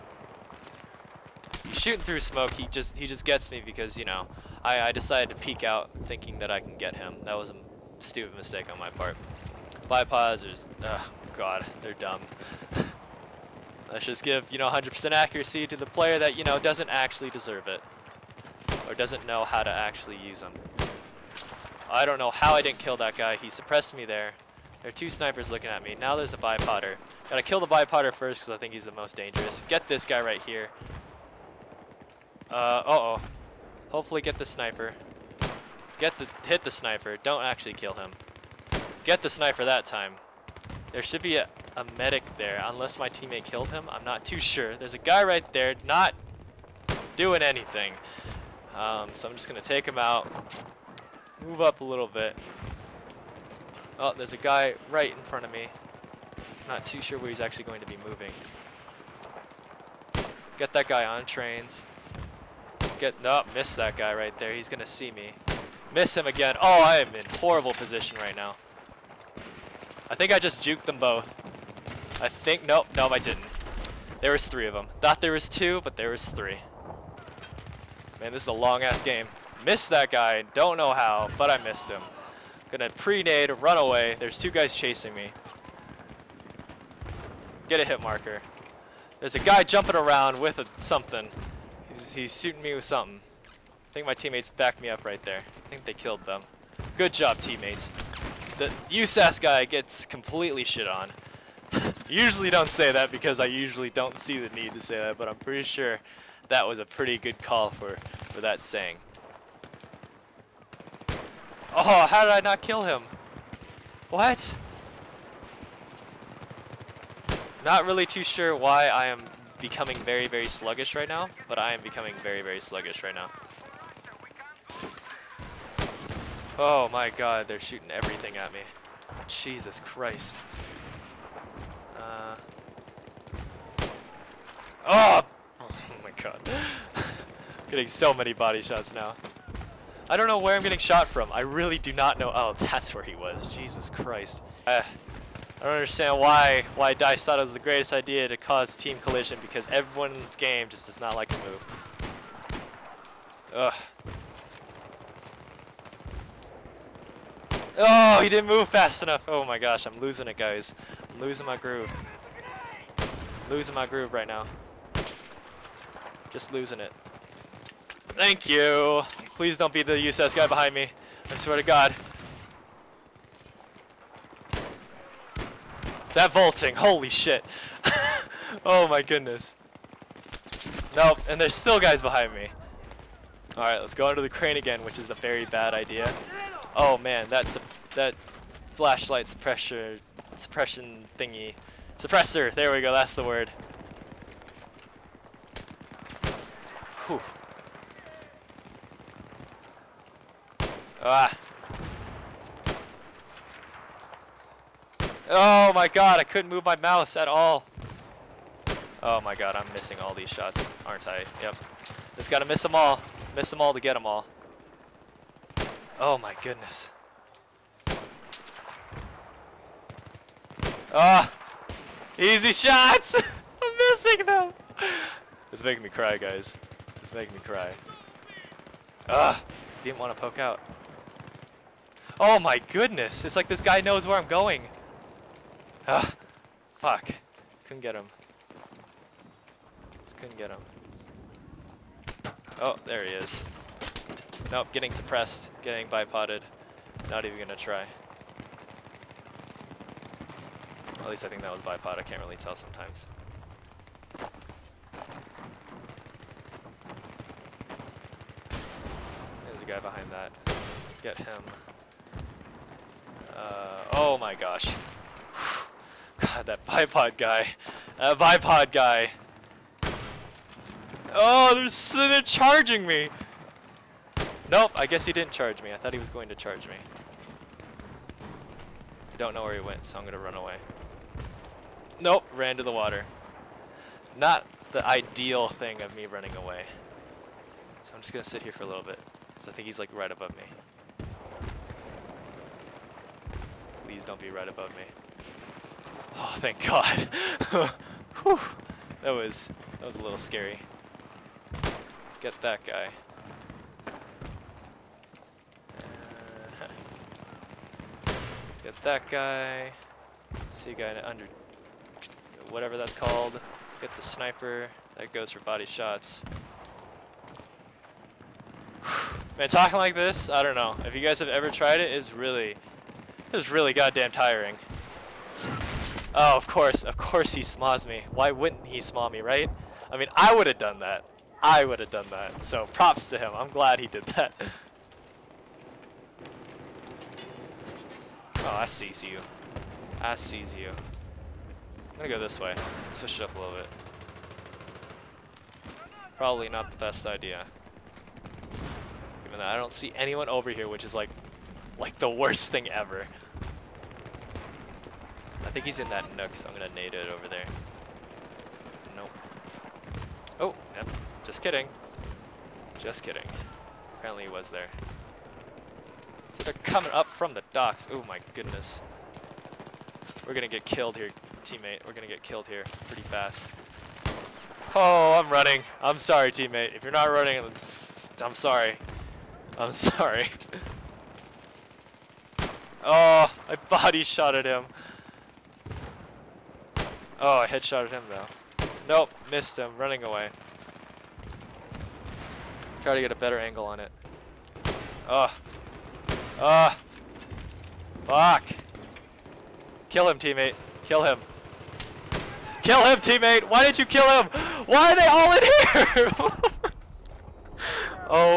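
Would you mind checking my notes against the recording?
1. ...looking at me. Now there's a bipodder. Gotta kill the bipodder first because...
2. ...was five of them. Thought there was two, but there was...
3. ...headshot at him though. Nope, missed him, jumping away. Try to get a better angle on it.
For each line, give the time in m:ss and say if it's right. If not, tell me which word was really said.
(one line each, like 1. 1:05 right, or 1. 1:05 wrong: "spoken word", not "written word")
1. 0:25 right
2. 1:14 wrong: "three", not "five"
3. 6:27 wrong: "running", not "jumping".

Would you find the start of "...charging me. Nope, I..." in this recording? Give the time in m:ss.
4:32.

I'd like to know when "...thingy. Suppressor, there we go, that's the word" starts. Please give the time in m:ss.
3:11.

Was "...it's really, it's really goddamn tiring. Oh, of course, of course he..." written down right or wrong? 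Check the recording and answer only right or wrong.
right.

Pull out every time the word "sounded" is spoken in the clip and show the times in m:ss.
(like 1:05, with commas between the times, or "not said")
not said.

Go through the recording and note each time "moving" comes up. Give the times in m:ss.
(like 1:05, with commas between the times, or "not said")
0:58.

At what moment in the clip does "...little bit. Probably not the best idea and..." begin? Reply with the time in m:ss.
5:43.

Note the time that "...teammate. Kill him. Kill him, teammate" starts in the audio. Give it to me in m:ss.
6:40.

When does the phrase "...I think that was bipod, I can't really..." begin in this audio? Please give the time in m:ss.
4:11.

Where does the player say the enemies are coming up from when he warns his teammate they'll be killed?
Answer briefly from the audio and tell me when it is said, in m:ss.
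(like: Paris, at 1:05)
the docks, at 6:07.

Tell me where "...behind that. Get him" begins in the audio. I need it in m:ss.
4:19.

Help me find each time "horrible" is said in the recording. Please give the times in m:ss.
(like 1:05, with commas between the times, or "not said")
1:07.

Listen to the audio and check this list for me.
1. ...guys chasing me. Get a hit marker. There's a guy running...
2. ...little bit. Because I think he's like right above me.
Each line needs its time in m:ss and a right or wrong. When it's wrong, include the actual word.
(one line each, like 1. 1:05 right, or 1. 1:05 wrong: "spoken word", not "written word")
1. 1:24 wrong: "jumping", not "running"
2. 4:48 right.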